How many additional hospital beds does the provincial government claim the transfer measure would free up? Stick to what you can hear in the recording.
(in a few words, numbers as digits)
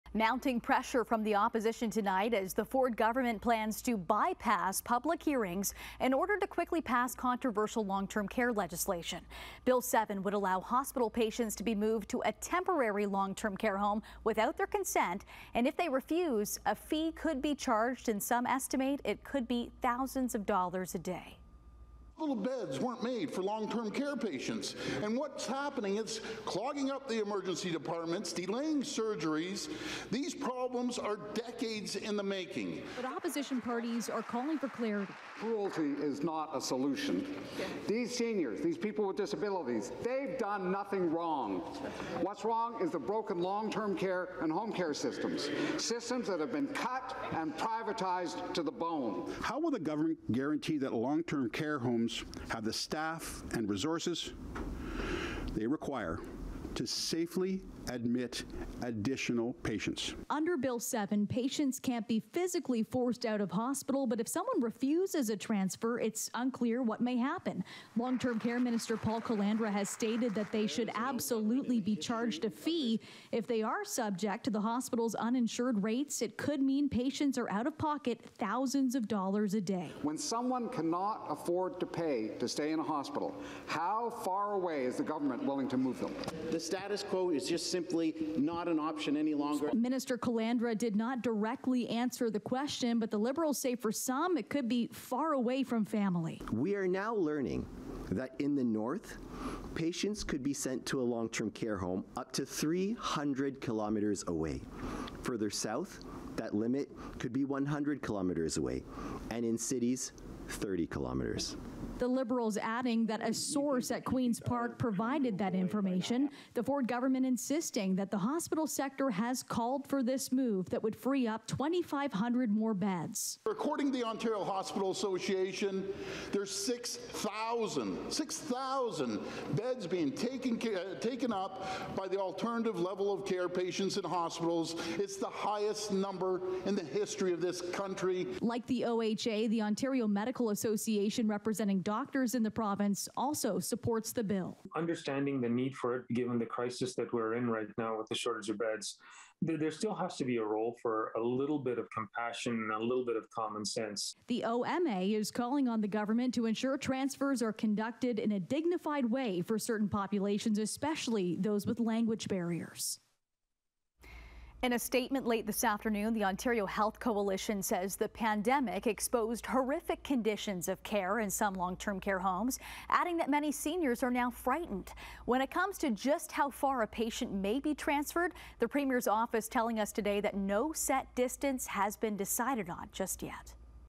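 2,500.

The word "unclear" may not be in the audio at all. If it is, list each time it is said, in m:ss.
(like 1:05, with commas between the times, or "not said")
1:06.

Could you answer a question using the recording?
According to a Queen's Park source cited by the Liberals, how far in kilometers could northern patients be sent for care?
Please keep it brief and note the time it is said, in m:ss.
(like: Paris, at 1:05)
300 kilometers, at 1:42.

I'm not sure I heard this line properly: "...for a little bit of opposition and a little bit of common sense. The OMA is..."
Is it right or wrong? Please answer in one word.
wrong.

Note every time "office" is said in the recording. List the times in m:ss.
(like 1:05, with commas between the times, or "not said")
2:59.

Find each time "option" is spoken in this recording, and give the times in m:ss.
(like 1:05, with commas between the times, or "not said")
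1:28.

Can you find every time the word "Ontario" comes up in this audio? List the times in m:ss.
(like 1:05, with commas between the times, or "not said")
2:04, 2:19, 2:46.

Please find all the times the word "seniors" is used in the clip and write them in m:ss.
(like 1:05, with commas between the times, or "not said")
0:38, 2:53.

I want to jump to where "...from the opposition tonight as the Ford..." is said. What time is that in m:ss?
0:01.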